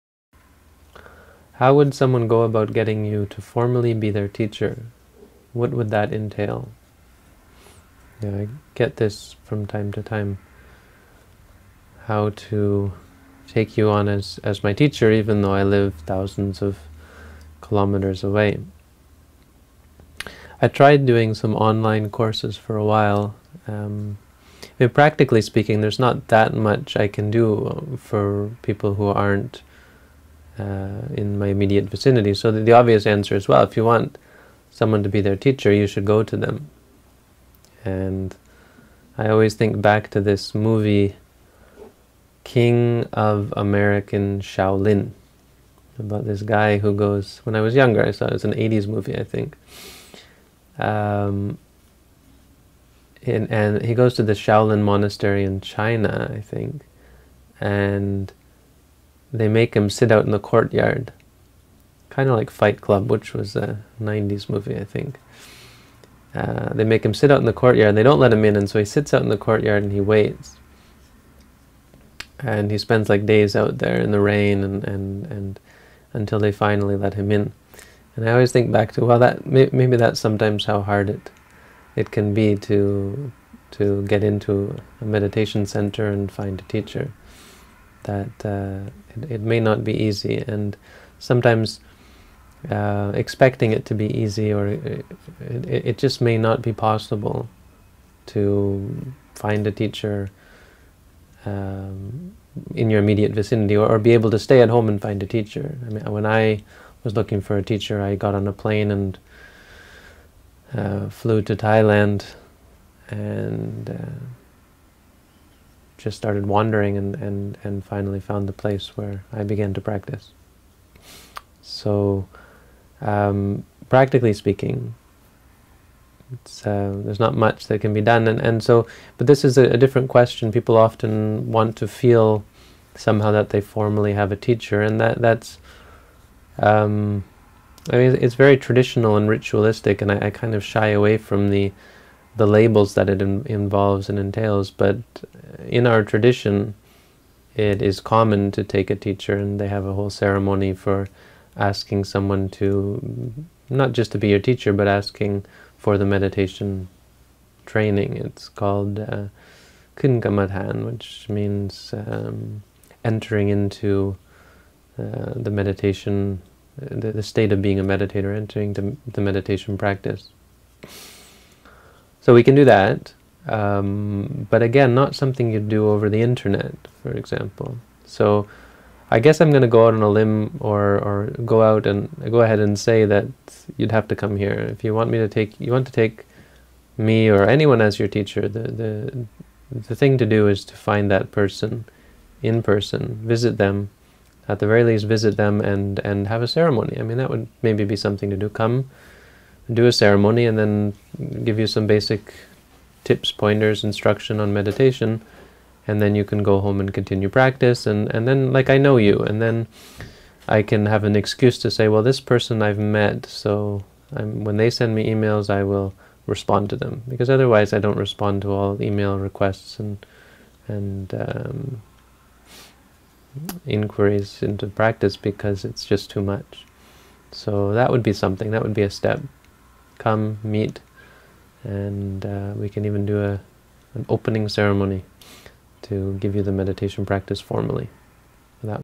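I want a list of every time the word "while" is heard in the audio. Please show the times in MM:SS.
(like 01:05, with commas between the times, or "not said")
00:22.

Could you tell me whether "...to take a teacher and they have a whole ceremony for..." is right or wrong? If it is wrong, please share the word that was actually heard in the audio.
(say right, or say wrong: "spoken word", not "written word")
right.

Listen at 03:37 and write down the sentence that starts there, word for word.
Because otherwise, I don't respond to all email requests and, and um, inquiries into practice because it's just too much.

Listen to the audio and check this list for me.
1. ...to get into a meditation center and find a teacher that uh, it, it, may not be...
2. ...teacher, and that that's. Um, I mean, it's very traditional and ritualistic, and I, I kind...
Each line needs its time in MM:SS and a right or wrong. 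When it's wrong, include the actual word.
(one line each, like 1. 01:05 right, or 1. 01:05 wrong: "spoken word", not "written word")
1. 01:23 right
2. 02:14 right.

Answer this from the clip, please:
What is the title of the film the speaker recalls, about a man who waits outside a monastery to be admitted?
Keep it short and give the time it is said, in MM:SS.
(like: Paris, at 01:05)
King of American Shaolin, at 00:42.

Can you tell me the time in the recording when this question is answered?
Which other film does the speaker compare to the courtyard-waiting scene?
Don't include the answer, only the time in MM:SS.
01:02.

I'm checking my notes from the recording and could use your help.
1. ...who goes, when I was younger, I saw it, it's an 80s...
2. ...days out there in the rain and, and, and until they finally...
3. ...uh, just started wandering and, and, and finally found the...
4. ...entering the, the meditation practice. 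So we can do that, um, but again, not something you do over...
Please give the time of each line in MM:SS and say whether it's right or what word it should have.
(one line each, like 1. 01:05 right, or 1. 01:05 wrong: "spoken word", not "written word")
1. 00:46 right
2. 01:13 right
3. 01:53 right
4. 02:48 right.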